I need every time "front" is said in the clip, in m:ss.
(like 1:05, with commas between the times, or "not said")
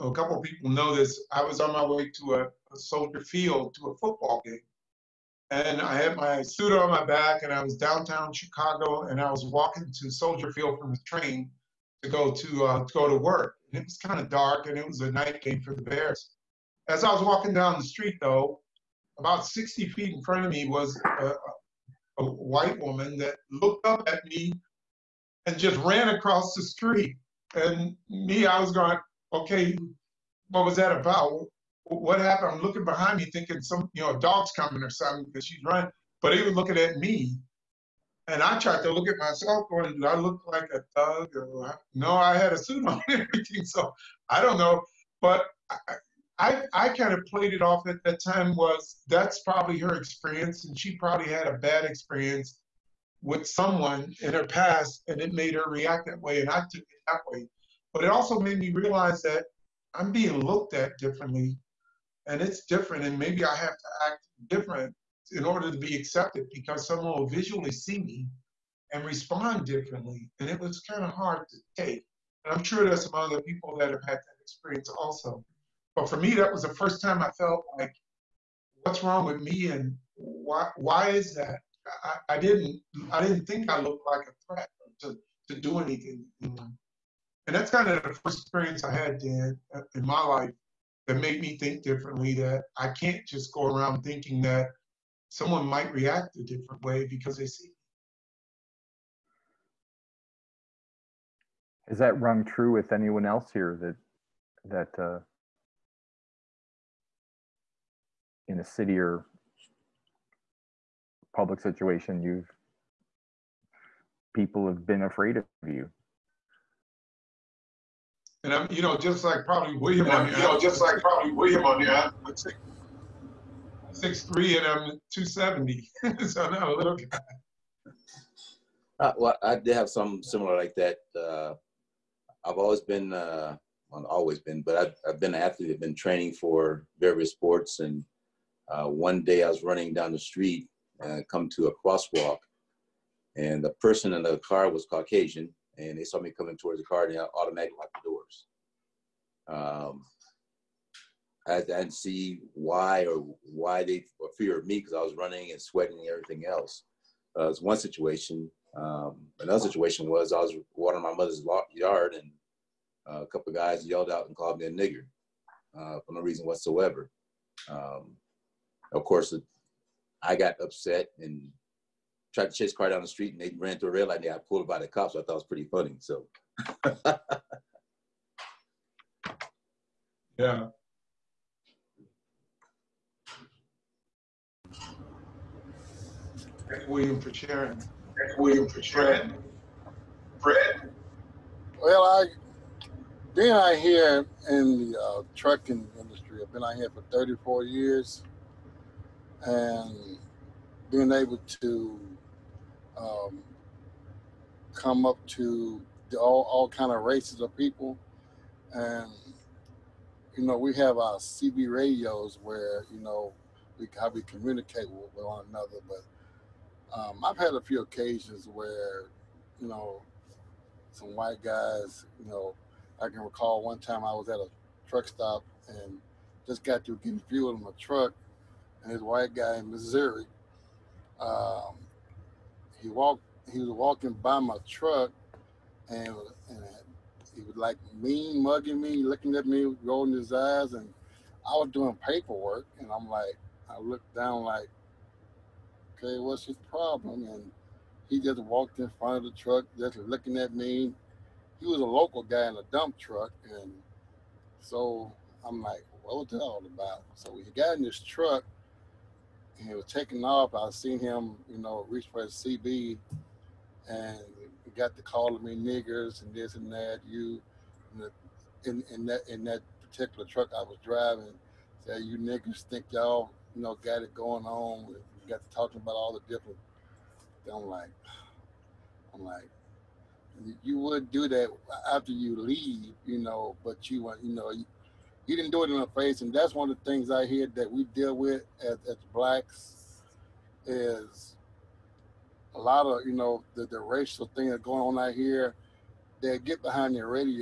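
0:20, 4:08.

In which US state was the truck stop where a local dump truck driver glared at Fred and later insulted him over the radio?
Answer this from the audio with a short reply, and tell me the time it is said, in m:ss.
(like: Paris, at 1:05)
Missouri, at 3:49.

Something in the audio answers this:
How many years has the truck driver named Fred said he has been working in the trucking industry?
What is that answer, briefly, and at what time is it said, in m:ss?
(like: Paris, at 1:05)
34, at 3:17.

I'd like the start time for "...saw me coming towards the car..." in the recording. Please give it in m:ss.
2:26.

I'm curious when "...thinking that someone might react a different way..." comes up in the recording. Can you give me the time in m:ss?
1:34.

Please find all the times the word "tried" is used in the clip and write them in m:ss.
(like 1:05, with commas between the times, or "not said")
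0:38, 2:52.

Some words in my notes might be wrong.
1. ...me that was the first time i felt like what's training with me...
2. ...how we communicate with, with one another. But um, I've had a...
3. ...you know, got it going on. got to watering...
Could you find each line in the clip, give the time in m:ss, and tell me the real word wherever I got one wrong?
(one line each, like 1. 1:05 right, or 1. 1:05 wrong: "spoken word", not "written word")
1. 1:16 wrong: "wrong", not "training"
2. 3:33 right
3. 4:33 wrong: "talking", not "watering".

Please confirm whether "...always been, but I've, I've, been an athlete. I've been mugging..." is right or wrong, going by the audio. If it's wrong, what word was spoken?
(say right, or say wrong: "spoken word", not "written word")
wrong: "training", not "mugging".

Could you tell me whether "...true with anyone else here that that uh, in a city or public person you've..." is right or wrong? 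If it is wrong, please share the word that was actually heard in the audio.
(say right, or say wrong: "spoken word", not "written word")
wrong: "situation", not "person".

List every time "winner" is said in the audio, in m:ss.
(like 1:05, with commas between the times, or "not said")
not said.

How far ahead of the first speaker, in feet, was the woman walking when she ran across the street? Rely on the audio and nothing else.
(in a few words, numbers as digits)
60 feet.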